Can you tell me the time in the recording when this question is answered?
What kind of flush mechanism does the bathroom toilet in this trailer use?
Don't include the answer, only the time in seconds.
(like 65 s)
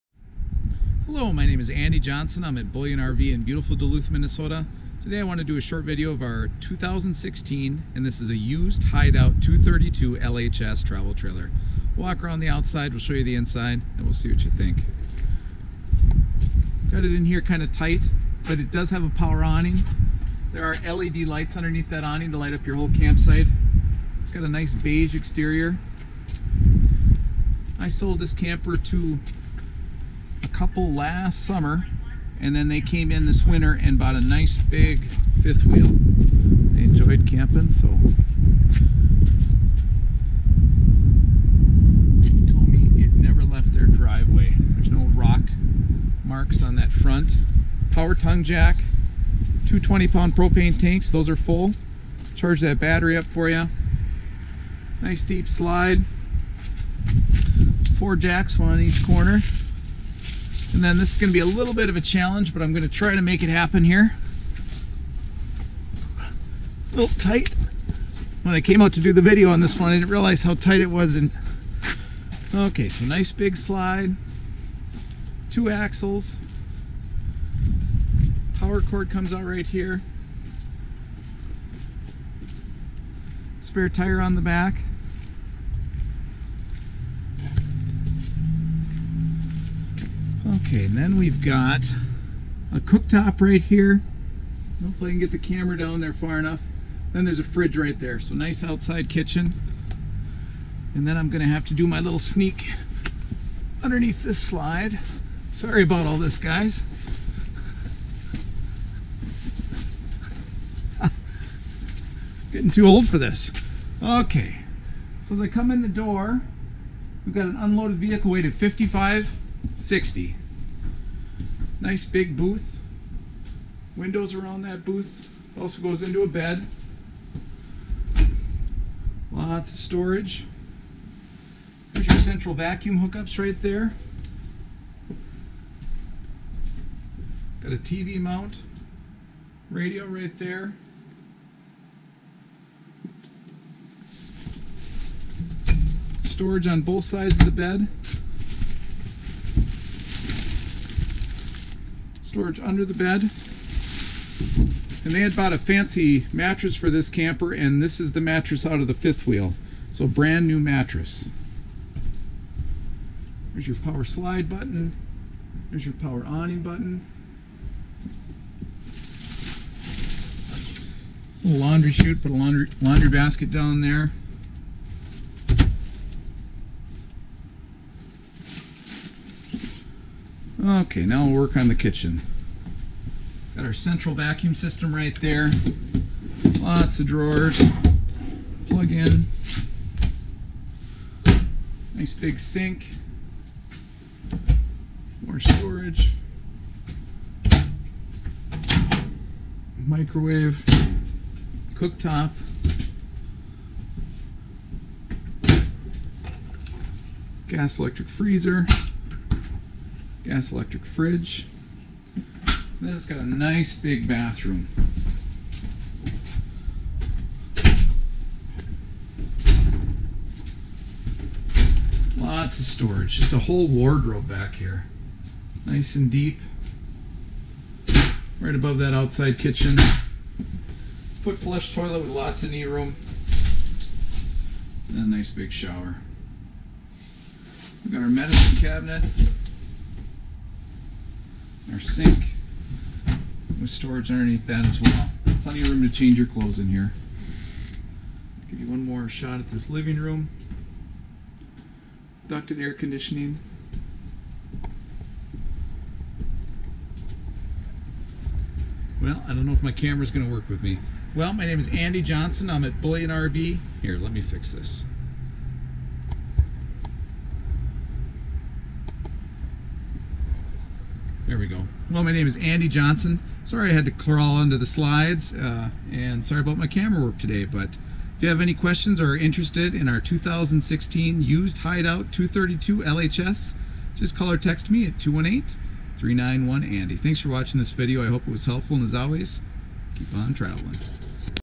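231 s.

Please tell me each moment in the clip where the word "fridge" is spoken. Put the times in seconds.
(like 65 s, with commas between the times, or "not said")
97 s, 210 s.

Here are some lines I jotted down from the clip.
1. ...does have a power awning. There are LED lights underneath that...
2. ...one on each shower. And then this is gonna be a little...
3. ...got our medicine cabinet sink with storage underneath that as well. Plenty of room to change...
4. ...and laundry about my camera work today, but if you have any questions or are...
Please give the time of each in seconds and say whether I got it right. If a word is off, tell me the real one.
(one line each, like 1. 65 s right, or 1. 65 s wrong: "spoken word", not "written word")
1. 18 s right
2. 58 s wrong: "corner", not "shower"
3. 237 s right
4. 275 s wrong: "sorry", not "laundry".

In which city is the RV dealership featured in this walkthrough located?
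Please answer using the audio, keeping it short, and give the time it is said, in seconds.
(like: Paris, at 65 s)
Duluth, Minnesota, at 3 s.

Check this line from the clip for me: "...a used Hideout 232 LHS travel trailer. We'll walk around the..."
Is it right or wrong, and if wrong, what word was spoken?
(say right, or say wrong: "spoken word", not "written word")
right.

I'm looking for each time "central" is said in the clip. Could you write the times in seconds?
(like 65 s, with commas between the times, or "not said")
132 s, 183 s.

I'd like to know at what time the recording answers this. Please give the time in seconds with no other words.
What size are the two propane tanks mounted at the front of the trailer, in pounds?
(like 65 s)
49 s.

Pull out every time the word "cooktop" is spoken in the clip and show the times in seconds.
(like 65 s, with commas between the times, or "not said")
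92 s, 201 s.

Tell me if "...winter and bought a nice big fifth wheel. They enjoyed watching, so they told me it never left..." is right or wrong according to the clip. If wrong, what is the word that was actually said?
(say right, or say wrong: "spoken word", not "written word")
wrong: "camping", not "watching".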